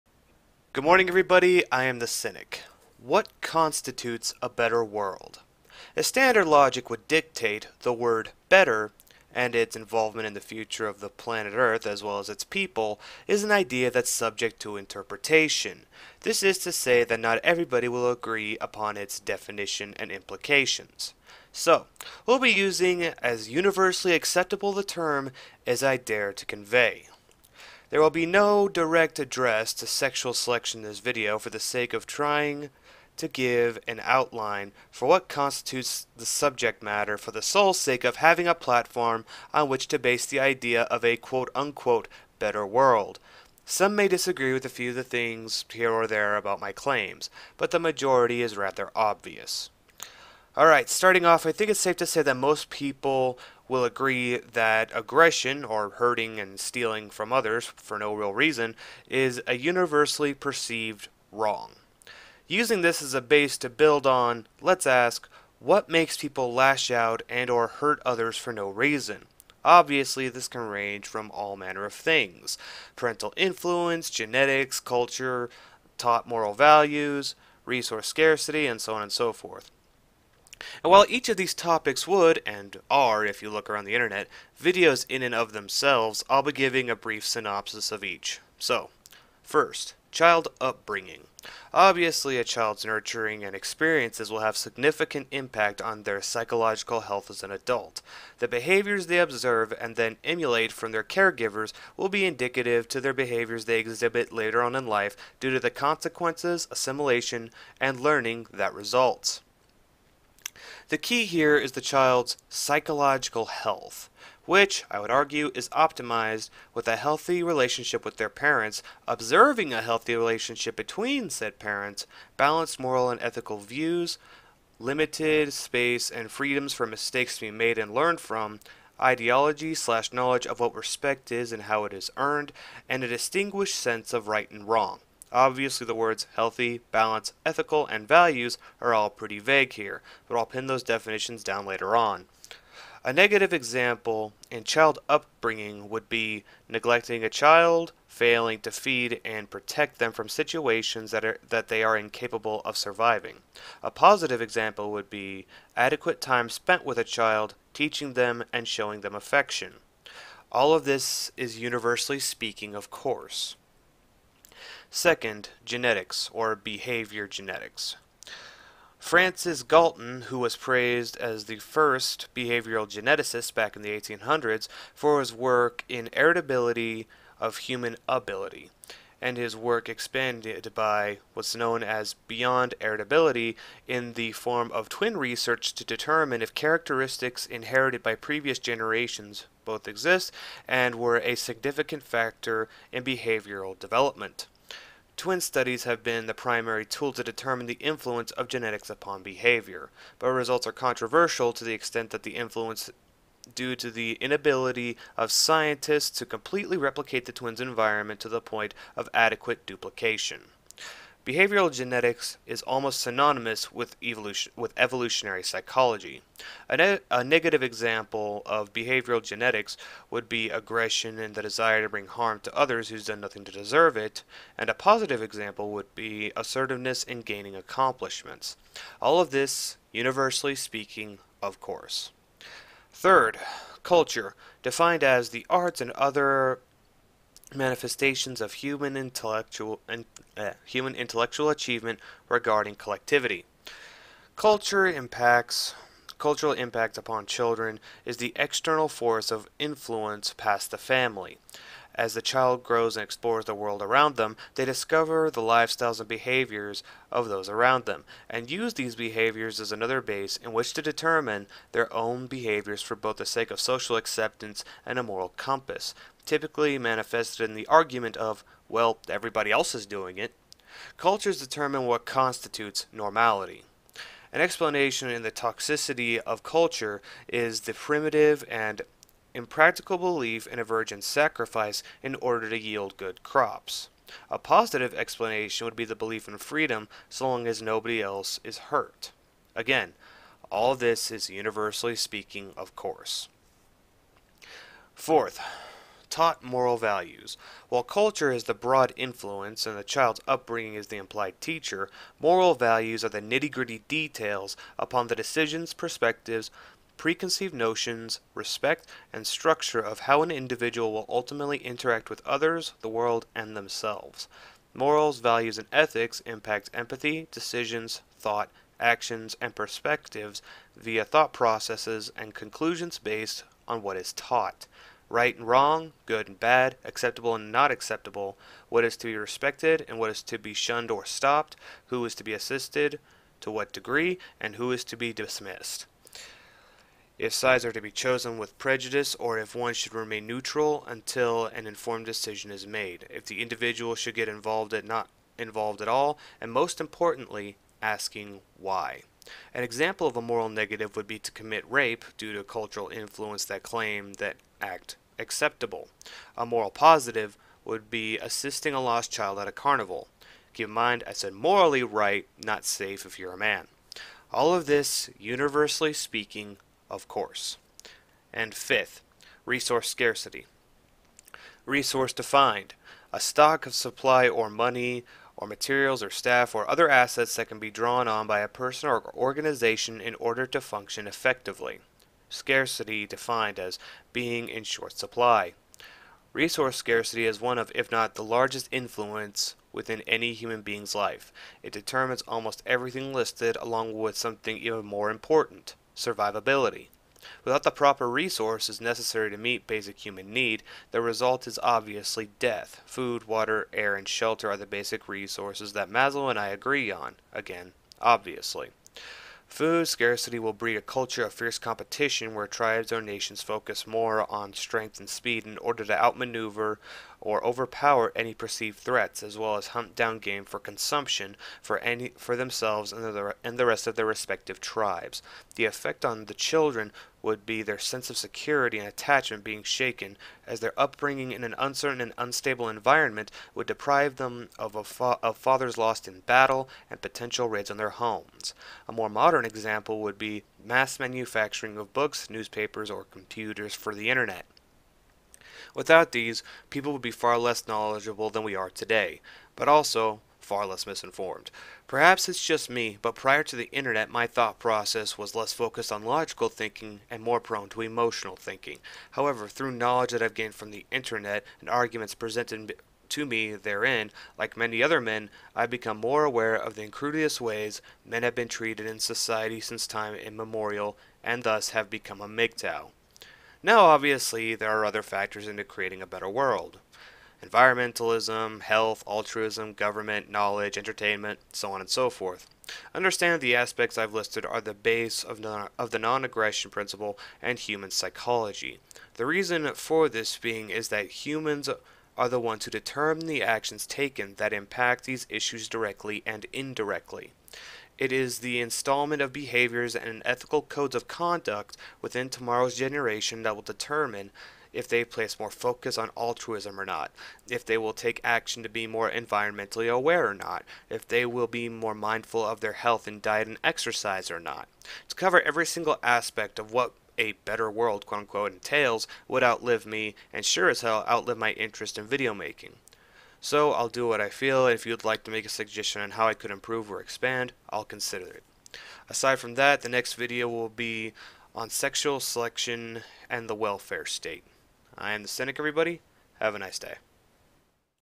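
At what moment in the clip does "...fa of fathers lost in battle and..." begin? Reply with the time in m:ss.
7:14.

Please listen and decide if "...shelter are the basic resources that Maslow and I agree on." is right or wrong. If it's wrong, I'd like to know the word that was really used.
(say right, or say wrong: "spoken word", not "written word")
right.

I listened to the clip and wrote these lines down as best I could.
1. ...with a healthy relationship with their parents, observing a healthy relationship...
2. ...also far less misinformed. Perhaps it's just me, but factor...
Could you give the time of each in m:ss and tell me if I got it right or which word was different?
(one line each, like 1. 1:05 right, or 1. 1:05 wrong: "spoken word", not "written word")
1. 1:56 right
2. 7:29 wrong: "prior", not "factor".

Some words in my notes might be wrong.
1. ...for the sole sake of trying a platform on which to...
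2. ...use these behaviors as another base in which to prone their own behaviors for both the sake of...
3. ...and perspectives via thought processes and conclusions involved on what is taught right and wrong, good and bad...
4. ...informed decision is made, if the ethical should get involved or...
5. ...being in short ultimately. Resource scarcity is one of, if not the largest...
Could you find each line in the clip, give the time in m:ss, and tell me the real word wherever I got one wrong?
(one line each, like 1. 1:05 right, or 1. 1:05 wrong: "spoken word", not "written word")
1. 0:37 wrong: "having", not "trying"
2. 4:18 wrong: "determine", not "prone"
3. 5:19 wrong: "based", not "involved"
4. 5:41 wrong: "individual", not "ethical"
5. 6:24 wrong: "supply", not "ultimately".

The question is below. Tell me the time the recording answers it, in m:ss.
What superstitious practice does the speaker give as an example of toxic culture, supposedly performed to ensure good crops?
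4:40.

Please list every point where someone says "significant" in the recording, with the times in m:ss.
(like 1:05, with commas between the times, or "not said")
1:34, 3:11.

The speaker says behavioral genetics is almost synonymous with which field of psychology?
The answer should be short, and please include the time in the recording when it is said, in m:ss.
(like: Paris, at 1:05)
Evolutionary psychology, at 3:34.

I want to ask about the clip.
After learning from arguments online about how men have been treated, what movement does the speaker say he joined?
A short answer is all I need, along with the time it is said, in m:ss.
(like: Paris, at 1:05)
MGTOW, at 7:52.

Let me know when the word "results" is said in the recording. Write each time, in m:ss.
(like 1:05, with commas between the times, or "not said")
1:48, 3:20, 6:41.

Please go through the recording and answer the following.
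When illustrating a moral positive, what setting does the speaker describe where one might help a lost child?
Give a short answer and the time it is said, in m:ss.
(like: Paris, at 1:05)
A carnival, at 5:59.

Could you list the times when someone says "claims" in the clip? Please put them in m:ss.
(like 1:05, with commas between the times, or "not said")
0:46, 5:53.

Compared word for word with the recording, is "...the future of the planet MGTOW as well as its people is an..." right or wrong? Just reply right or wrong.
wrong.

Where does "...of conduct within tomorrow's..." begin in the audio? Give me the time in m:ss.
8:20.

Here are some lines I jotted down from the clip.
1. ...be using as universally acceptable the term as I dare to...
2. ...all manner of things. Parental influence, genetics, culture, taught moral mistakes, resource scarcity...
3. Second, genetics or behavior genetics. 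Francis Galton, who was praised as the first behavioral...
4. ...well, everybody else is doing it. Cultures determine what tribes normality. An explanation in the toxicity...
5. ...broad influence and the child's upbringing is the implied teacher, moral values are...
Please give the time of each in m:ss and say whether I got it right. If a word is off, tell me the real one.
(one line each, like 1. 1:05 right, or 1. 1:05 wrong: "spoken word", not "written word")
1. 0:22 right
2. 1:11 wrong: "values", not "mistakes"
3. 2:44 right
4. 4:28 wrong: "constitutes", not "tribes"
5. 4:58 right.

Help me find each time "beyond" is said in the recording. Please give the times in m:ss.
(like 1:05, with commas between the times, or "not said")
3:02.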